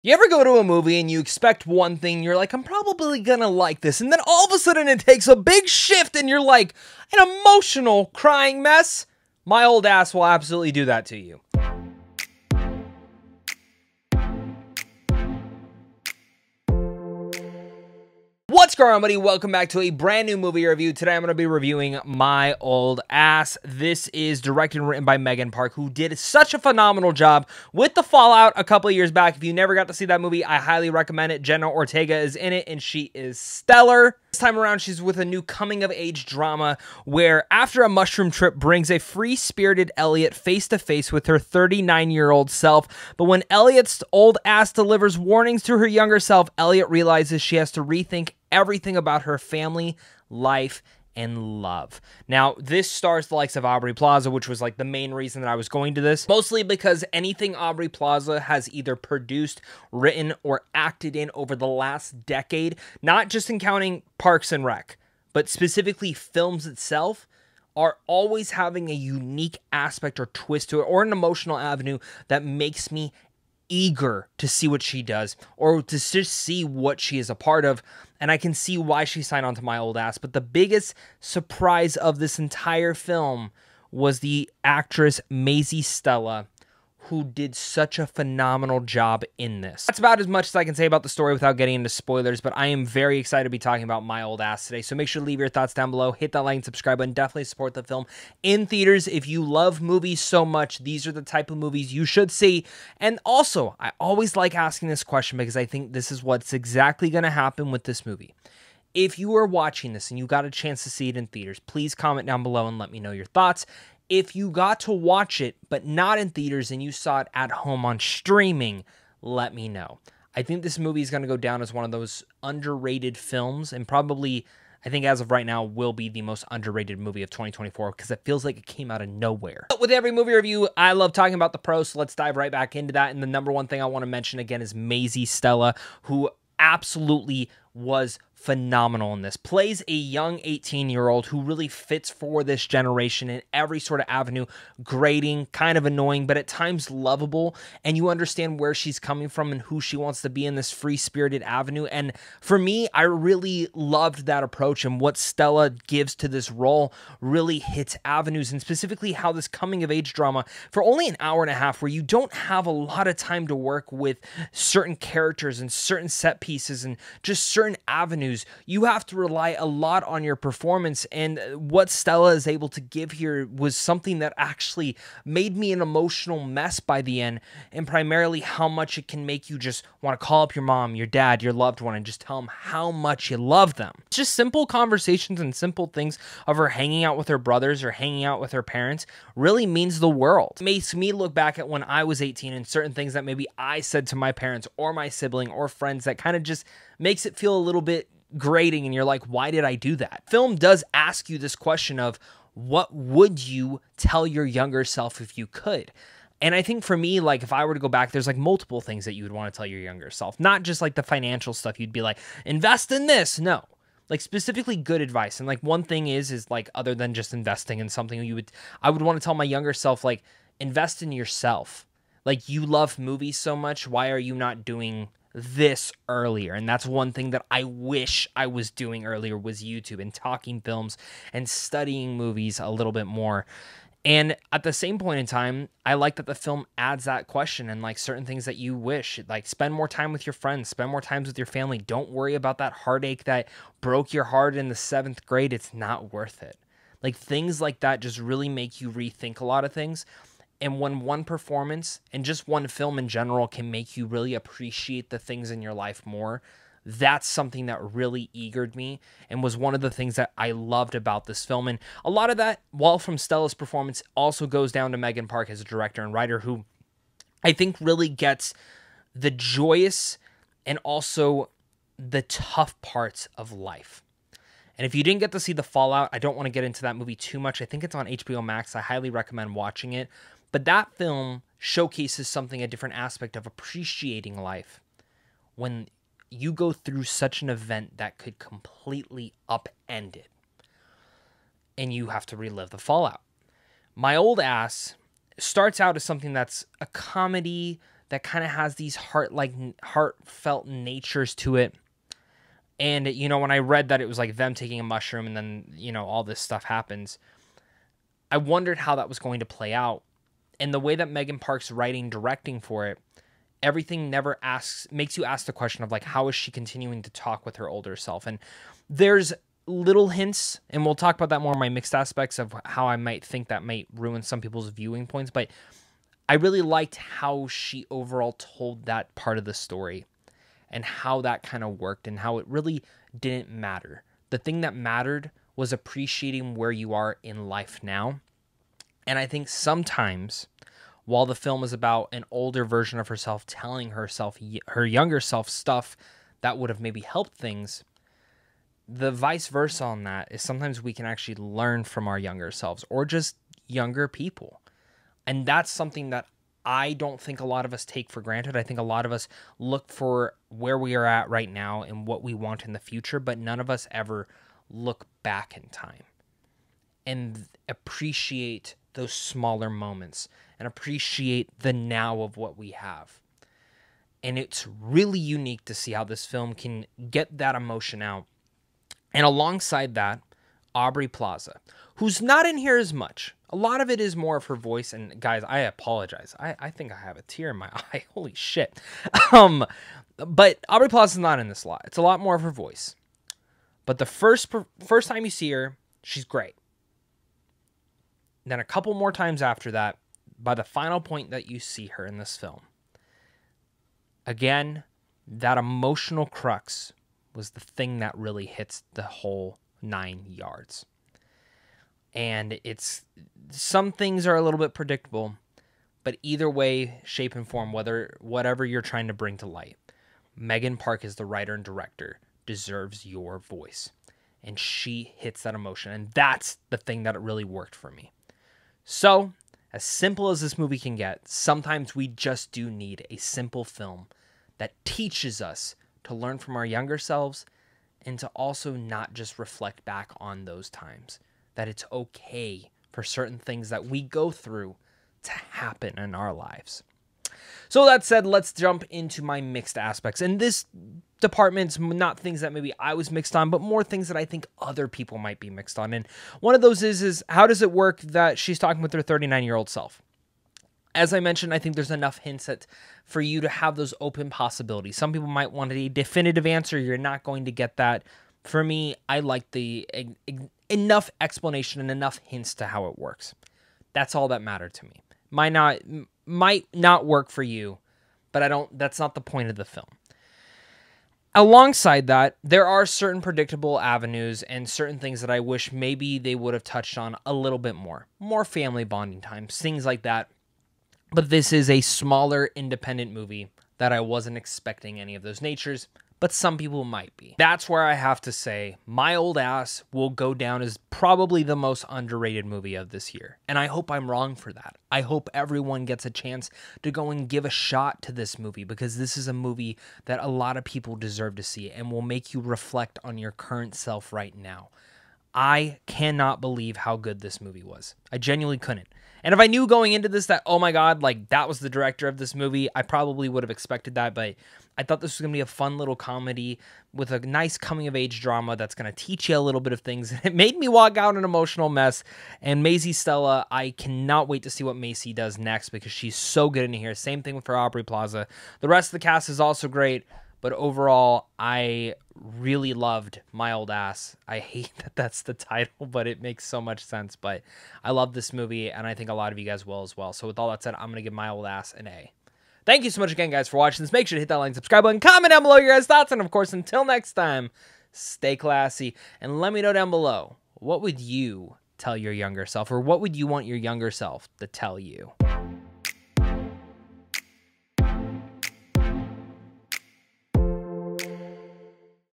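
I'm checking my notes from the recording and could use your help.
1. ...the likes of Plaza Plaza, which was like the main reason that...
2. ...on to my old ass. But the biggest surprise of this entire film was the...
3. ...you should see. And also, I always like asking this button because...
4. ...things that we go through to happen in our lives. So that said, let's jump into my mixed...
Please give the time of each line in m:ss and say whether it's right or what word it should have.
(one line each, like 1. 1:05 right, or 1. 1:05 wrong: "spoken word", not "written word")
1. 0:53 wrong: "Aubrey", not "Plaza"
2. 1:19 right
3. 1:41 wrong: "question", not "button"
4. 7:23 right.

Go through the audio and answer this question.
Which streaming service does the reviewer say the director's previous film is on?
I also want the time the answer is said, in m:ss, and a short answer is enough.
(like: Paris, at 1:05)
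HBO Max, at 4:38.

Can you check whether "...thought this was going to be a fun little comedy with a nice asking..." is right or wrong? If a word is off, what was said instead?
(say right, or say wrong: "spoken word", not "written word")
wrong: "coming", not "asking".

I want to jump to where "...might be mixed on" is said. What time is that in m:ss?
7:35.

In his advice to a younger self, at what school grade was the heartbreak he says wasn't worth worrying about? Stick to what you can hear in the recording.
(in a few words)
Seventh grade.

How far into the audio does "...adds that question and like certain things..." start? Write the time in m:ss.
3:56.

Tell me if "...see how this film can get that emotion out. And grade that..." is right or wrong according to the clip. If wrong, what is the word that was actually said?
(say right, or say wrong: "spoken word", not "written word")
wrong: "alongside", not "grade".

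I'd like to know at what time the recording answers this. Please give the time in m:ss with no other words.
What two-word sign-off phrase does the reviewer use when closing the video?
9:17.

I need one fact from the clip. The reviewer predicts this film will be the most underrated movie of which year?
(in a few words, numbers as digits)
2024.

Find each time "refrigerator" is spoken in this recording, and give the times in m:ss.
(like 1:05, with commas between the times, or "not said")
not said.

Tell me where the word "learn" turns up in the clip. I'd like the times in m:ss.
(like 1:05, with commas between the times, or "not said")
5:51, 7:16.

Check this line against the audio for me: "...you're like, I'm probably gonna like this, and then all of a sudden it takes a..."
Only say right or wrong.
right.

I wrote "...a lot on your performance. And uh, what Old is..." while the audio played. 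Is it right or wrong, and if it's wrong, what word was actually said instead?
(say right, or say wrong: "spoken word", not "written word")
wrong: "Stella", not "Old".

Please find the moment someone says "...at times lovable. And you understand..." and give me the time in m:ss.
2:26.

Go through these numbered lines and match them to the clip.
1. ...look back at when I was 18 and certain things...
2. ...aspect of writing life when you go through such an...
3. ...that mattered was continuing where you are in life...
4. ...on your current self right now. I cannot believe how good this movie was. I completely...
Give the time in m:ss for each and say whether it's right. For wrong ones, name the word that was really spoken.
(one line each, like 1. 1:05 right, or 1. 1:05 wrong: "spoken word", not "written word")
1. 3:11 right
2. 4:42 wrong: "appreciating", not "writing"
3. 5:34 wrong: "appreciating", not "continuing"
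4. 8:33 wrong: "genuinely", not "completely".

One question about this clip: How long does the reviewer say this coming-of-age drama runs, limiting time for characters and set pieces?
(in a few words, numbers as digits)
An hour and a half.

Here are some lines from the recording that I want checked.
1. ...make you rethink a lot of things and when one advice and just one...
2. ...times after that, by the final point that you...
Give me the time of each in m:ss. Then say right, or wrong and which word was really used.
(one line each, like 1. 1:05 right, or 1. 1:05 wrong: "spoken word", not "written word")
1. 4:08 wrong: "performance", not "advice"
2. 6:39 right.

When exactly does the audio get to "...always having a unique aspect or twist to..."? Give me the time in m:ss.
1:08.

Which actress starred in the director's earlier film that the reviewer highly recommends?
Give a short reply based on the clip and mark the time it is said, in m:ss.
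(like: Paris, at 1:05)
Jenna Ortega, at 0:31.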